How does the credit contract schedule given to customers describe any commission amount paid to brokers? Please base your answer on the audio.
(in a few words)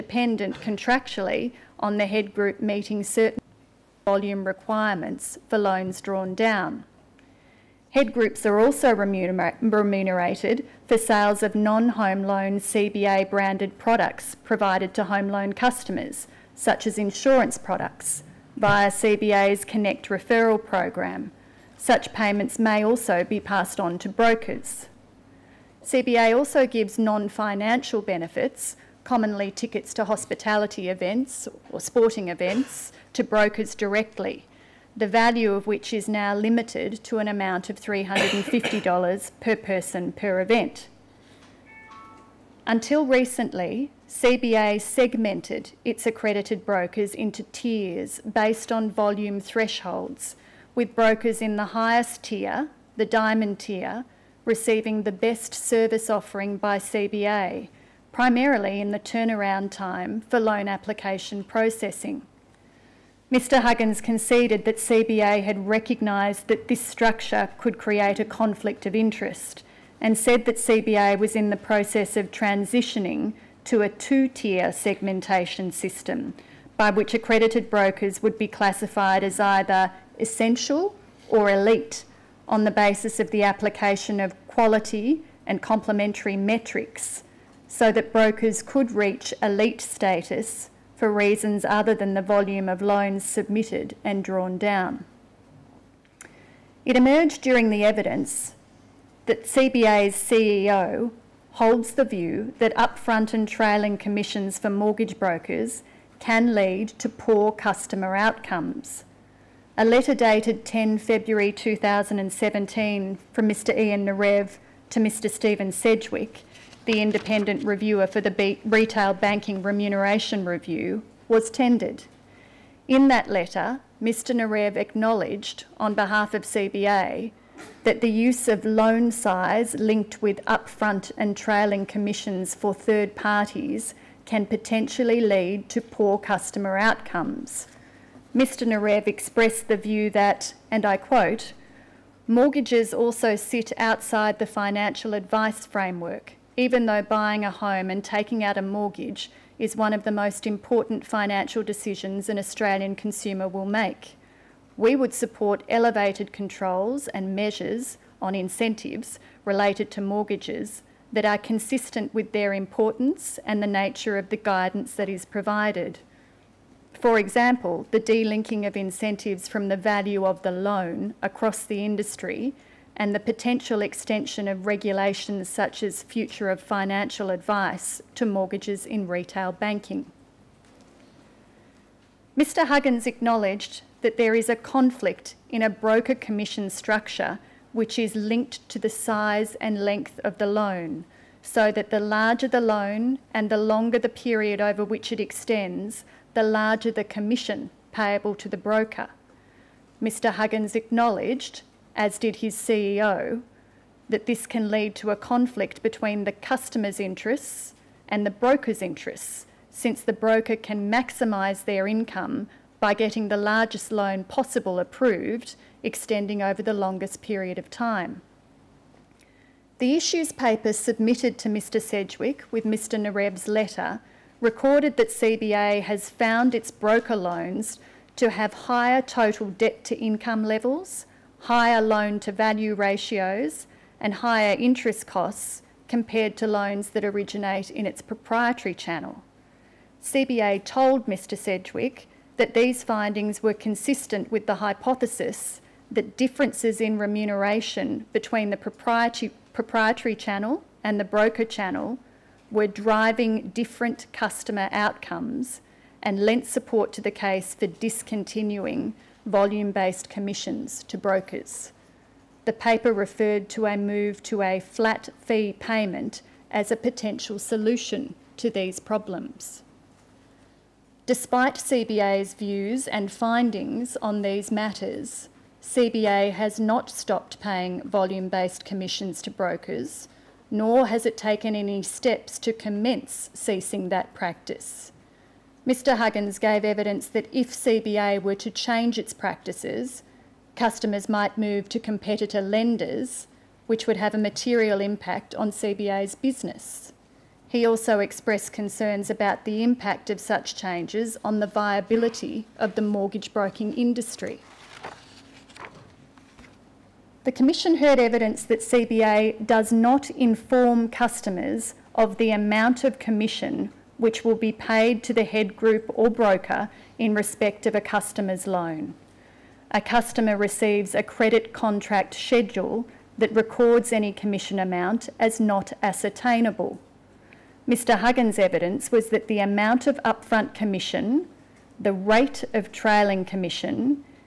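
not ascertainable.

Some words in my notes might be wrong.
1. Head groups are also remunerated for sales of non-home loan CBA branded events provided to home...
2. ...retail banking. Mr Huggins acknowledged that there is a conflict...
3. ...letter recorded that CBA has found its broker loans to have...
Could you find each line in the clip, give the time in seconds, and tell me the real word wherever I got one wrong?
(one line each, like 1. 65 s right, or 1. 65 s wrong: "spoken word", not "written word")
1. 7 s wrong: "products", not "events"
2. 179 s right
3. 223 s right.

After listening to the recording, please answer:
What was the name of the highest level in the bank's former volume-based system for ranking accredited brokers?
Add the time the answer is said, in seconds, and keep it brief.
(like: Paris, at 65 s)
diamond tier, at 53 s.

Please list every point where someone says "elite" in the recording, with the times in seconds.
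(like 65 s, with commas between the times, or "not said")
81 s, 89 s.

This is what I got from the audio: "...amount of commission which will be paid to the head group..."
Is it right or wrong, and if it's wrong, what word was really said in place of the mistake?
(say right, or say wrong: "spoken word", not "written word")
right.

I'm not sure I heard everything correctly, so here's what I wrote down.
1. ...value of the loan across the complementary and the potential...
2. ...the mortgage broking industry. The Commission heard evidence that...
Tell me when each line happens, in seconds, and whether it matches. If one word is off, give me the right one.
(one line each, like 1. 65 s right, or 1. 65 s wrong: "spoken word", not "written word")
1. 169 s wrong: "industry", not "complementary"
2. 302 s right.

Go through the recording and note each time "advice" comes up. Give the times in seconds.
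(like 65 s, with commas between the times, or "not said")
145 s, 177 s.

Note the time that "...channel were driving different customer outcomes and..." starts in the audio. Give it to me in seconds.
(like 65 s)
251 s.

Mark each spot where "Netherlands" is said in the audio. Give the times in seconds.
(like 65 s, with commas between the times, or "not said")
not said.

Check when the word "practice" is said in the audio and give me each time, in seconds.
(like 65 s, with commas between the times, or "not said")
284 s, 289 s.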